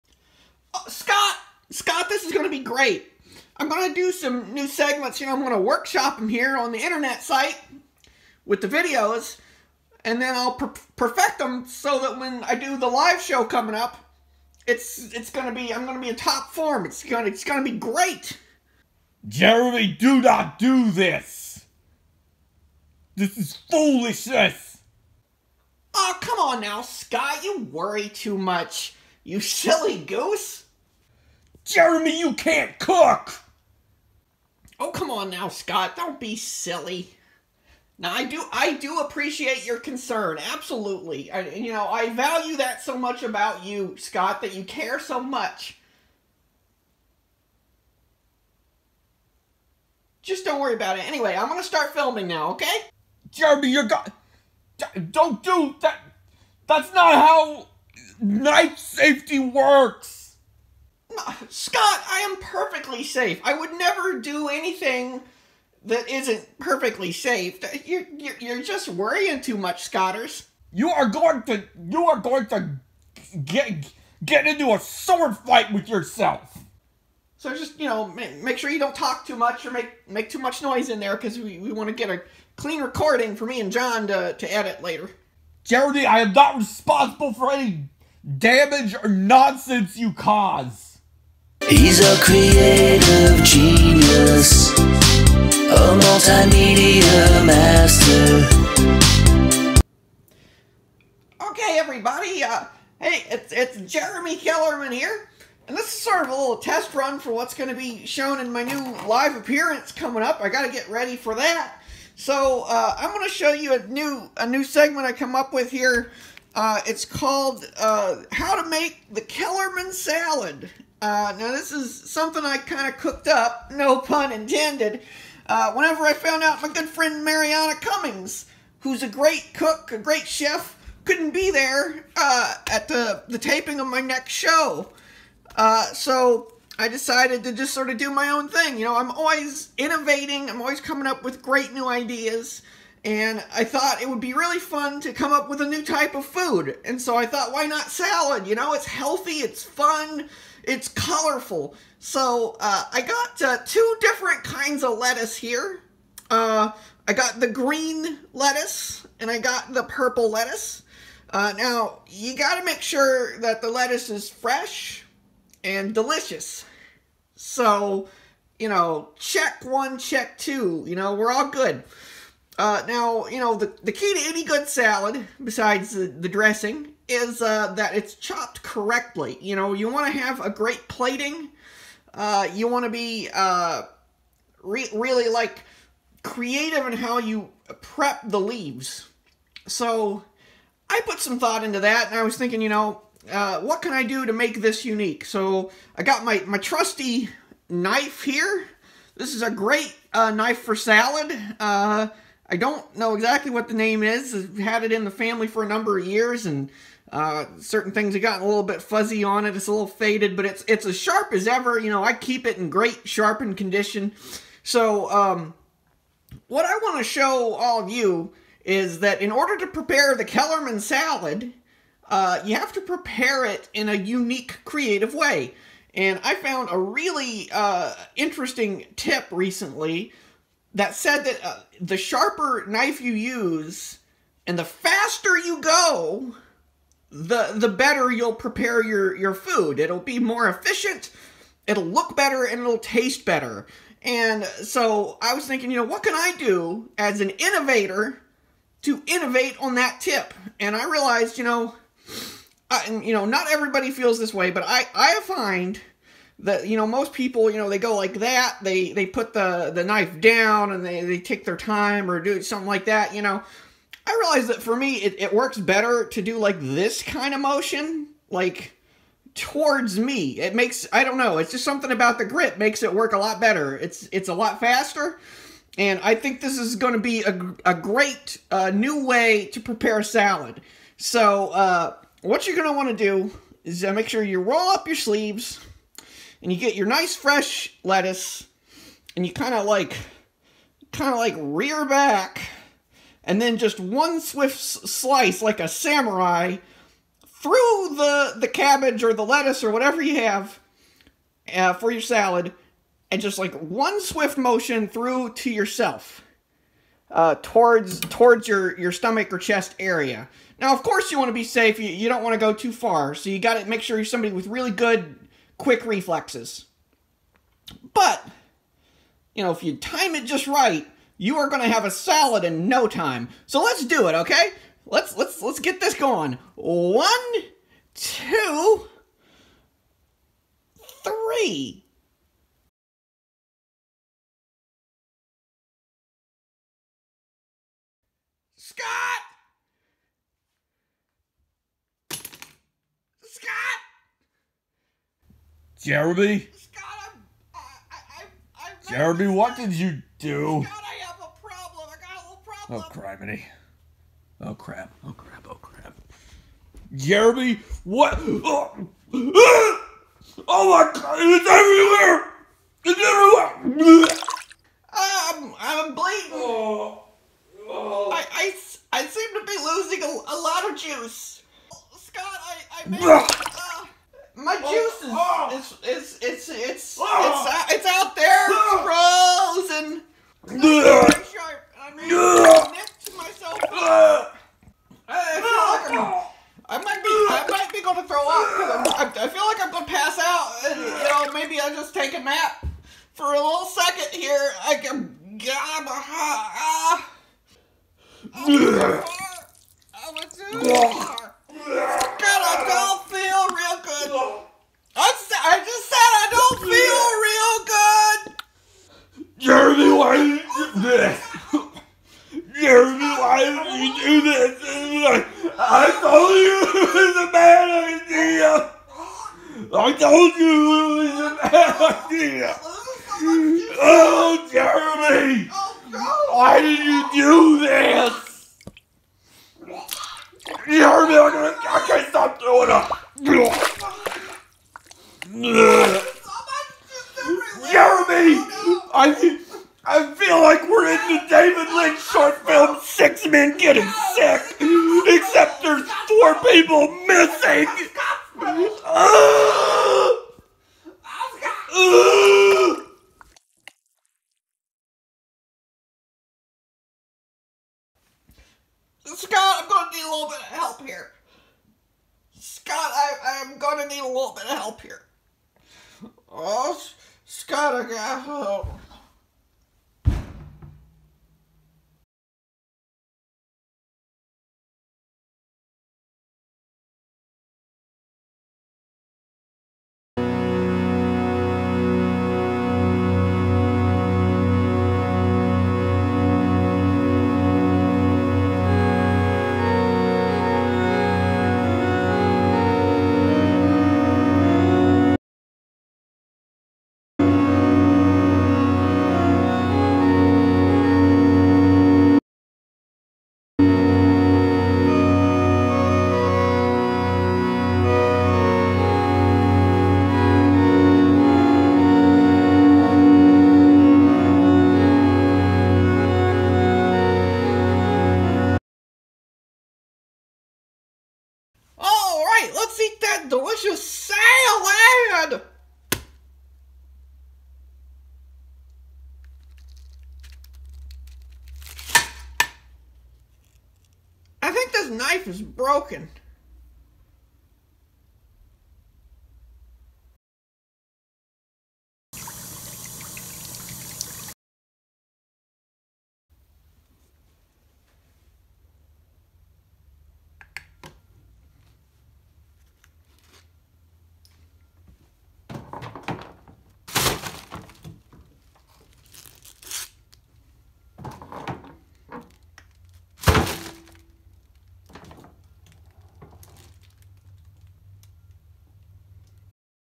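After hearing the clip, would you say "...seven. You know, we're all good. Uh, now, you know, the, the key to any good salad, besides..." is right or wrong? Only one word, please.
wrong.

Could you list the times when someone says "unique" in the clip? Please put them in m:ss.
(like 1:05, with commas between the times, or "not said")
3:14, 3:43.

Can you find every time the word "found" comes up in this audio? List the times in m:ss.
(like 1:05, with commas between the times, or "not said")
2:06, 3:46.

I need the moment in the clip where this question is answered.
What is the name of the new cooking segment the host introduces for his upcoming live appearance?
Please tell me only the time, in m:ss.
1:58.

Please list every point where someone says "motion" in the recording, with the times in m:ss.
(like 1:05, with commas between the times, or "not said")
4:27, 5:04.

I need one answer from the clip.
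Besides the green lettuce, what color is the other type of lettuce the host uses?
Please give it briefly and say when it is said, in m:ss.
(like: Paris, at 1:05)
Purple, at 2:39.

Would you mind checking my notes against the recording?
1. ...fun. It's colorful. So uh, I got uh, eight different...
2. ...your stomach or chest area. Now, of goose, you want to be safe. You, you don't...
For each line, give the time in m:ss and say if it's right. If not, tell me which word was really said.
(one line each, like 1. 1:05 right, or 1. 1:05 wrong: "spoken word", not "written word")
1. 2:29 wrong: "two", not "eight"
2. 5:08 wrong: "course", not "goose".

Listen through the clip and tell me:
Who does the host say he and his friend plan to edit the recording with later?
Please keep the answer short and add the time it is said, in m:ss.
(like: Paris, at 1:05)
John, at 1:23.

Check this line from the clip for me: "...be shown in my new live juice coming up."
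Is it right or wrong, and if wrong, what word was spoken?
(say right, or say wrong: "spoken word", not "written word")
wrong: "appearance", not "juice".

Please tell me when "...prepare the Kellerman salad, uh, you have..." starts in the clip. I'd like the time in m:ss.
3:39.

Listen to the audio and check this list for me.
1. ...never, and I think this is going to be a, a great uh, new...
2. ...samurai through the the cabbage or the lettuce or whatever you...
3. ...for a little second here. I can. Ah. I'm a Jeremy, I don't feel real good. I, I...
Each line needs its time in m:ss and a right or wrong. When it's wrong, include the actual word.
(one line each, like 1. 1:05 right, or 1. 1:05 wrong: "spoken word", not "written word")
1. 4:34 wrong: "faster", not "never"
2. 4:55 right
3. 6:33 wrong: "God", not "Jeremy".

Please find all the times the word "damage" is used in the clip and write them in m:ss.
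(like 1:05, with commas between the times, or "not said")
1:28.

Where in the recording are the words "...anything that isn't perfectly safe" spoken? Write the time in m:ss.
1:04.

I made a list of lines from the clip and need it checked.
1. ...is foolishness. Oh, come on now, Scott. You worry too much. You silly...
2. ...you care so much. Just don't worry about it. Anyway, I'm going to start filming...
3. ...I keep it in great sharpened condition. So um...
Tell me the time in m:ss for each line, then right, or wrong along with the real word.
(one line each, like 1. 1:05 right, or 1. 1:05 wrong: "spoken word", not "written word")
1. 0:23 right
2. 0:44 right
3. 3:32 right.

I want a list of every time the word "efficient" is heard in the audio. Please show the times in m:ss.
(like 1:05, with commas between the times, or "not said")
4:00.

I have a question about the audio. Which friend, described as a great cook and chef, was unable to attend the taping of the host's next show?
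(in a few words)
Mariana Cummings.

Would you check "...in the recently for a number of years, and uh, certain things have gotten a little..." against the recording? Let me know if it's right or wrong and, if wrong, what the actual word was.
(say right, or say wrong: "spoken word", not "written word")
wrong: "family", not "recently".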